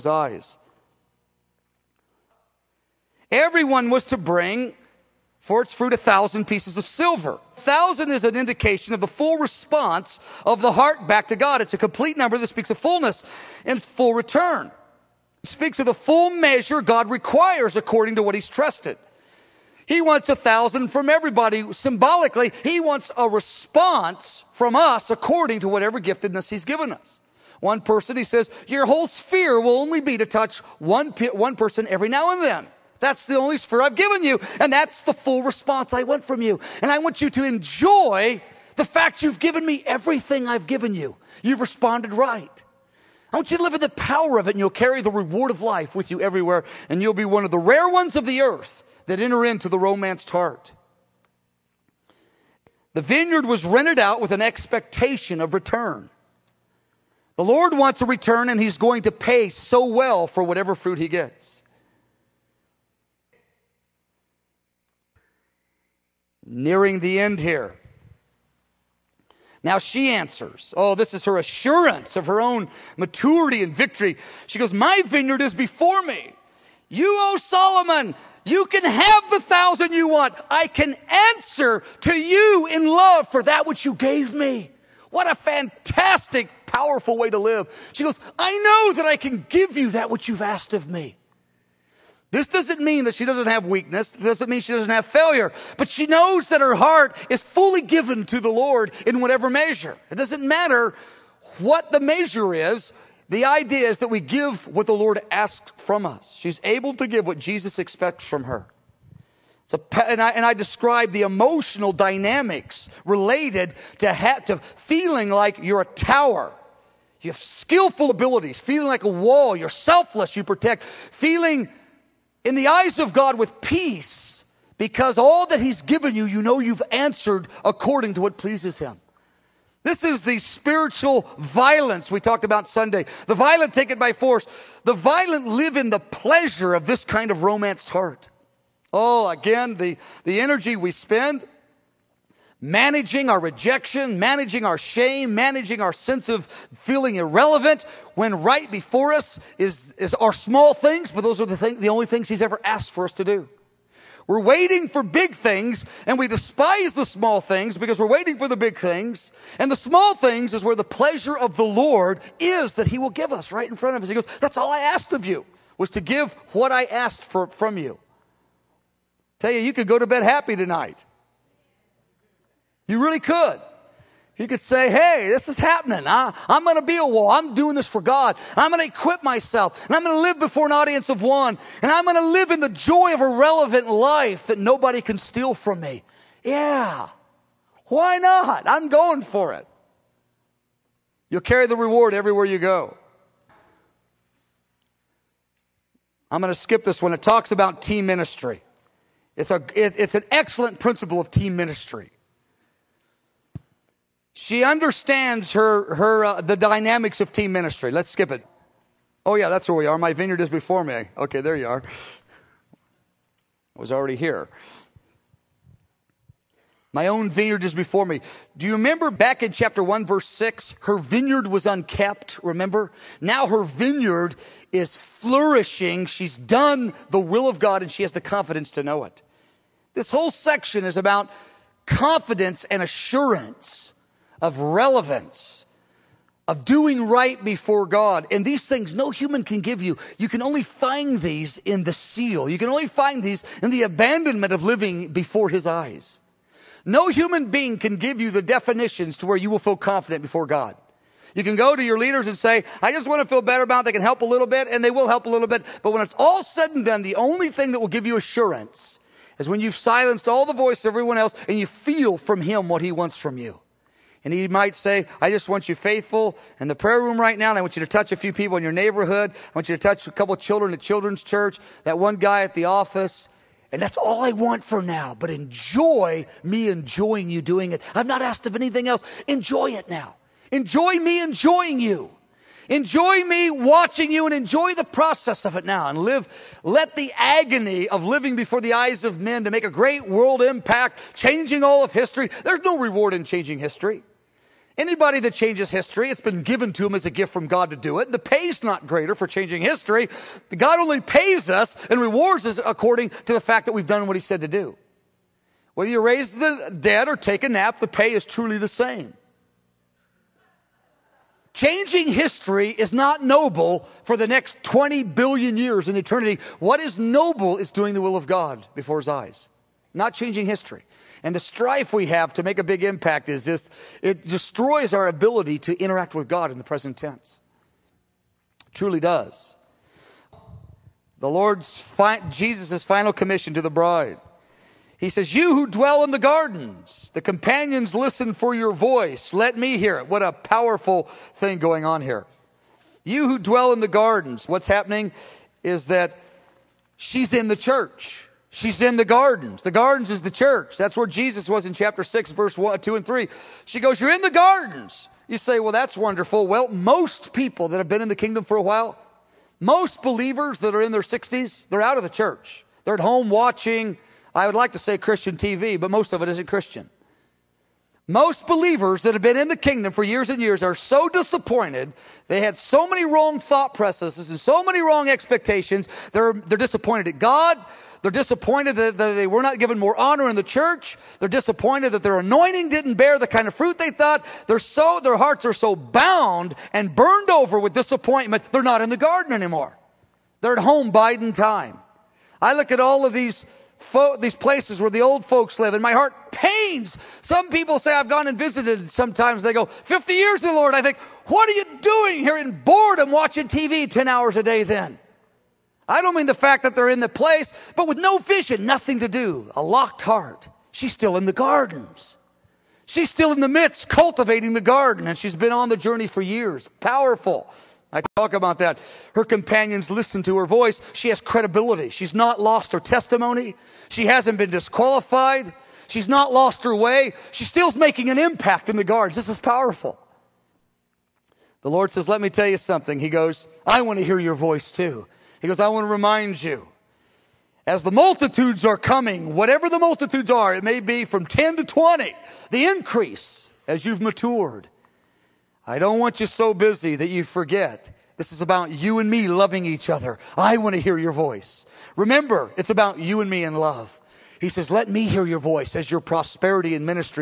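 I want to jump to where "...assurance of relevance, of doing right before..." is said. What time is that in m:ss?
3:52.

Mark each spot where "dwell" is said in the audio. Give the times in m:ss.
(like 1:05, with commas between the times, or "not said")
5:35, 5:43.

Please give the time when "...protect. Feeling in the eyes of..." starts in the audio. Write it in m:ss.
2:00.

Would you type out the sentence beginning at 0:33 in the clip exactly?
That's the only sphere I've given you.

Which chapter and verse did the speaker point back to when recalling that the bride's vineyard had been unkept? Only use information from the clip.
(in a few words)
Chapter 1, verse 6.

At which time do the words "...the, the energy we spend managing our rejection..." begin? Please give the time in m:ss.
2:19.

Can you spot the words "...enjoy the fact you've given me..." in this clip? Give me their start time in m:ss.
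0:37.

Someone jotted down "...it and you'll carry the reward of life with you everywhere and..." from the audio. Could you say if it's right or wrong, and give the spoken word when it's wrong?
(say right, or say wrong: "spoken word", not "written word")
right.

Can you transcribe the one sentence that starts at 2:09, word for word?
This is the spiritual violence we talked about Sunday.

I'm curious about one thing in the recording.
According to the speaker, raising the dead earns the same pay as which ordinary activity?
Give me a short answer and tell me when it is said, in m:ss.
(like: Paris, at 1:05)
Take a nap, at 5:07.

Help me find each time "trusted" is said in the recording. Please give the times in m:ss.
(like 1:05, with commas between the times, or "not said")
0:18.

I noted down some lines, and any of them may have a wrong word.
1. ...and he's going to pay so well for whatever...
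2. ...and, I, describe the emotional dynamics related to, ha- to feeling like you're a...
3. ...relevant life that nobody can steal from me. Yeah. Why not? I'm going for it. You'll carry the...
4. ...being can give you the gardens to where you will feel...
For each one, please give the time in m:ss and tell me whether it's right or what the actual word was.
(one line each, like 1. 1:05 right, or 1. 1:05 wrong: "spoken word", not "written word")
1. 0:58 right
2. 1:50 right
3. 3:03 right
4. 4:07 wrong: "definitions", not "gardens".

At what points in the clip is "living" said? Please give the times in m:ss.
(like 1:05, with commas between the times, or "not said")
4:04, 4:48.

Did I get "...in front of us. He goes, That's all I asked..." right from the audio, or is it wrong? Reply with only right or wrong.
right.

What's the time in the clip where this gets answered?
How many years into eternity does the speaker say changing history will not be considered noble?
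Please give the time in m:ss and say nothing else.
5:14.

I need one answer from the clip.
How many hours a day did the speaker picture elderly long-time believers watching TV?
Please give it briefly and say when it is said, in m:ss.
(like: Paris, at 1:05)
10, at 6:43.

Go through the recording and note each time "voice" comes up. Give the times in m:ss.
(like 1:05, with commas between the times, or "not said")
4:20, 5:38, 7:00, 7:14, 7:31, 7:35.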